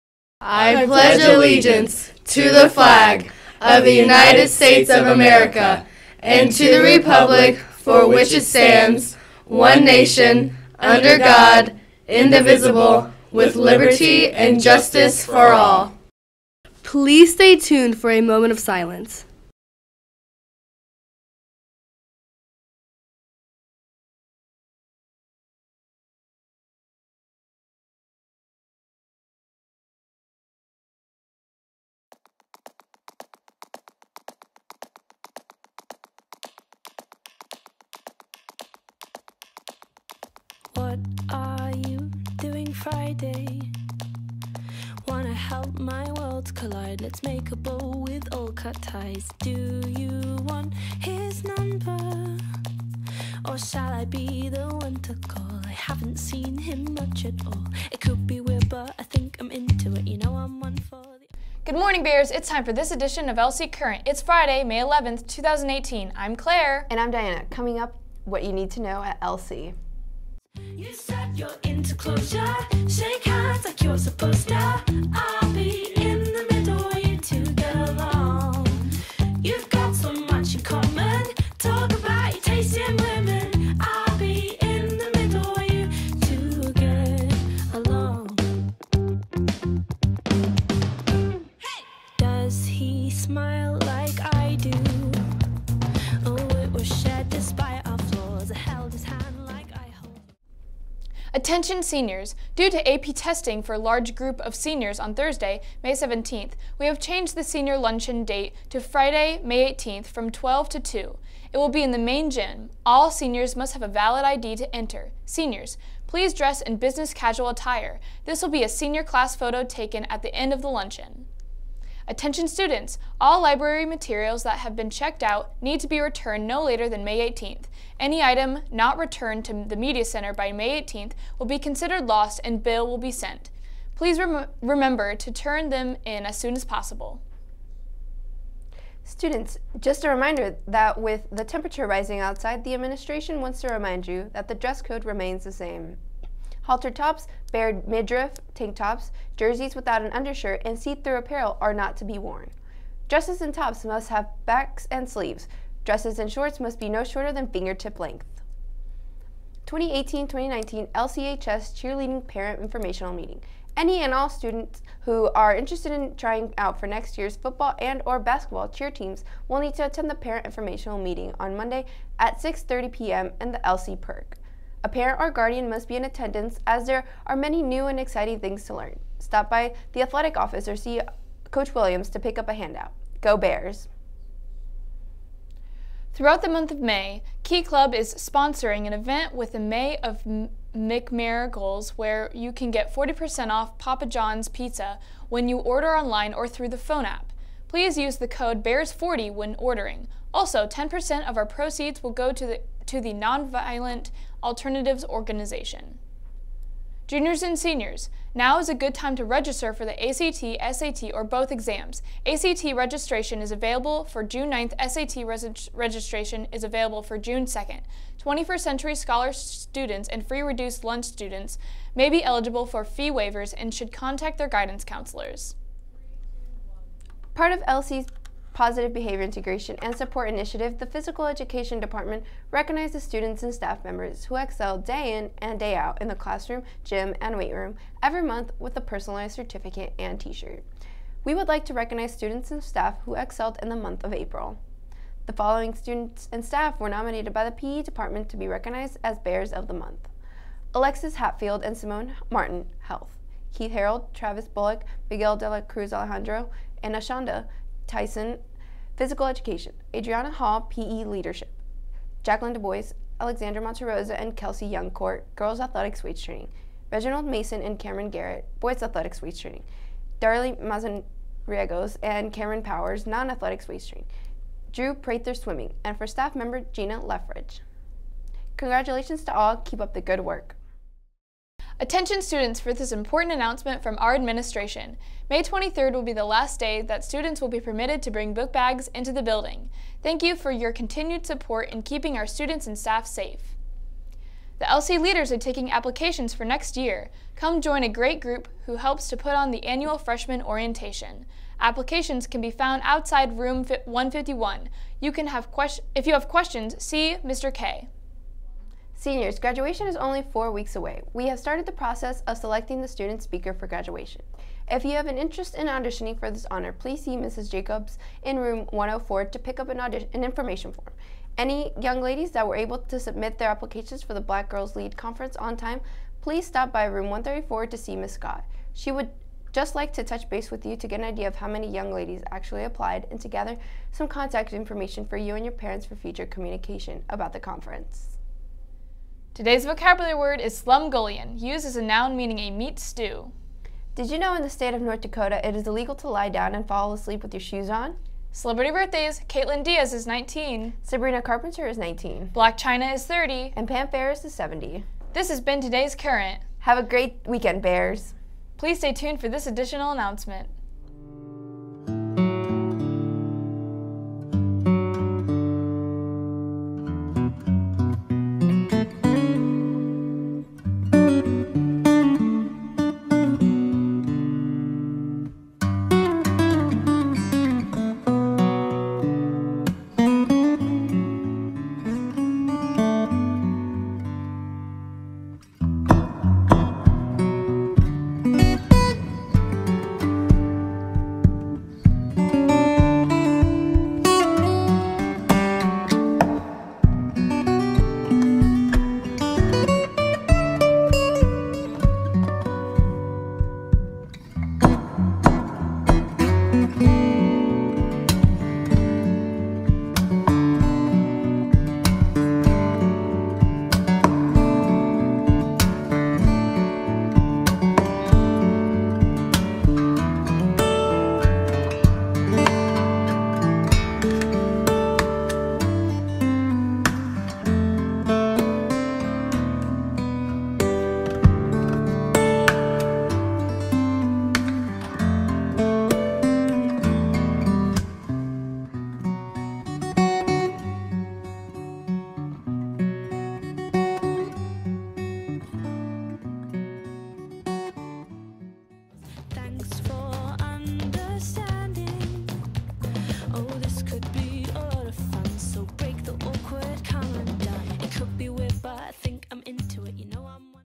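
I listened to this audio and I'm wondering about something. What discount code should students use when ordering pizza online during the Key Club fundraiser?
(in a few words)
BEARS40.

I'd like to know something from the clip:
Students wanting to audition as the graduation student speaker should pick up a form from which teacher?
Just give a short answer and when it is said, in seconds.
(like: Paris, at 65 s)
Mrs. Jacobs, at 317 s.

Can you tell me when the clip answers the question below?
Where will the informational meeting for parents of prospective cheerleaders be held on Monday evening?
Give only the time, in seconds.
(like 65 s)
173 s.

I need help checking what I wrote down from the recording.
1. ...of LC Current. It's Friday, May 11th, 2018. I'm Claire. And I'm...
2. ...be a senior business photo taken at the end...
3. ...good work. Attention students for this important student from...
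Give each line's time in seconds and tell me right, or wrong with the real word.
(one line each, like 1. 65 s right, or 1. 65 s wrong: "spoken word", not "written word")
1. 63 s right
2. 118 s wrong: "class", not "business"
3. 280 s wrong: "announcement", not "student".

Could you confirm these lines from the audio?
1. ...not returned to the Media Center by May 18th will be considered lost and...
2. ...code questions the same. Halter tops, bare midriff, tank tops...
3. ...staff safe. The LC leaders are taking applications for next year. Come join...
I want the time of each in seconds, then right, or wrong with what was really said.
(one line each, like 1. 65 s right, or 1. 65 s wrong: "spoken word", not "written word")
1. 128 s right
2. 144 s wrong: "remains", not "questions"
3. 292 s right.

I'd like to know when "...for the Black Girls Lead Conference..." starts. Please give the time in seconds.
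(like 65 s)
324 s.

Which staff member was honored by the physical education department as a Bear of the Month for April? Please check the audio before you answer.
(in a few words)
Gina Leffridge.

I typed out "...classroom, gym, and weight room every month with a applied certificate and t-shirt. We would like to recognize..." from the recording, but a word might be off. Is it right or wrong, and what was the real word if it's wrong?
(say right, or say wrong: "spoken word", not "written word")
wrong: "personalized", not "applied".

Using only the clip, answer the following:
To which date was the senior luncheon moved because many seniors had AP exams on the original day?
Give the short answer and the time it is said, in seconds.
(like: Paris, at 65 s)
Friday, May 18th, at 108 s.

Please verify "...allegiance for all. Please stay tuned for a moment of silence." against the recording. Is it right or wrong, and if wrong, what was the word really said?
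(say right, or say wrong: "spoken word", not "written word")
wrong: "justice", not "allegiance".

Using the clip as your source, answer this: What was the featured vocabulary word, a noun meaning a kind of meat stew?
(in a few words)
slumgullion.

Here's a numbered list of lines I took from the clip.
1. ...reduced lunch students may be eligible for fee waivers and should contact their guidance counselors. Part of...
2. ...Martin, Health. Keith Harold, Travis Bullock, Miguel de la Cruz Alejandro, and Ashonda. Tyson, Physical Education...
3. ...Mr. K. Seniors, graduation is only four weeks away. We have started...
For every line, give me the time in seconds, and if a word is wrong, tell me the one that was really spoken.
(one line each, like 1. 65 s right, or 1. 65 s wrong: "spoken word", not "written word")
1. 220 s right
2. 252 s right
3. 307 s right.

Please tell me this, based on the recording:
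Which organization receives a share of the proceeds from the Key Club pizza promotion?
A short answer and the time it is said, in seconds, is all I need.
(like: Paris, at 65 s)
Nonviolent Alternatives Organization, at 203 s.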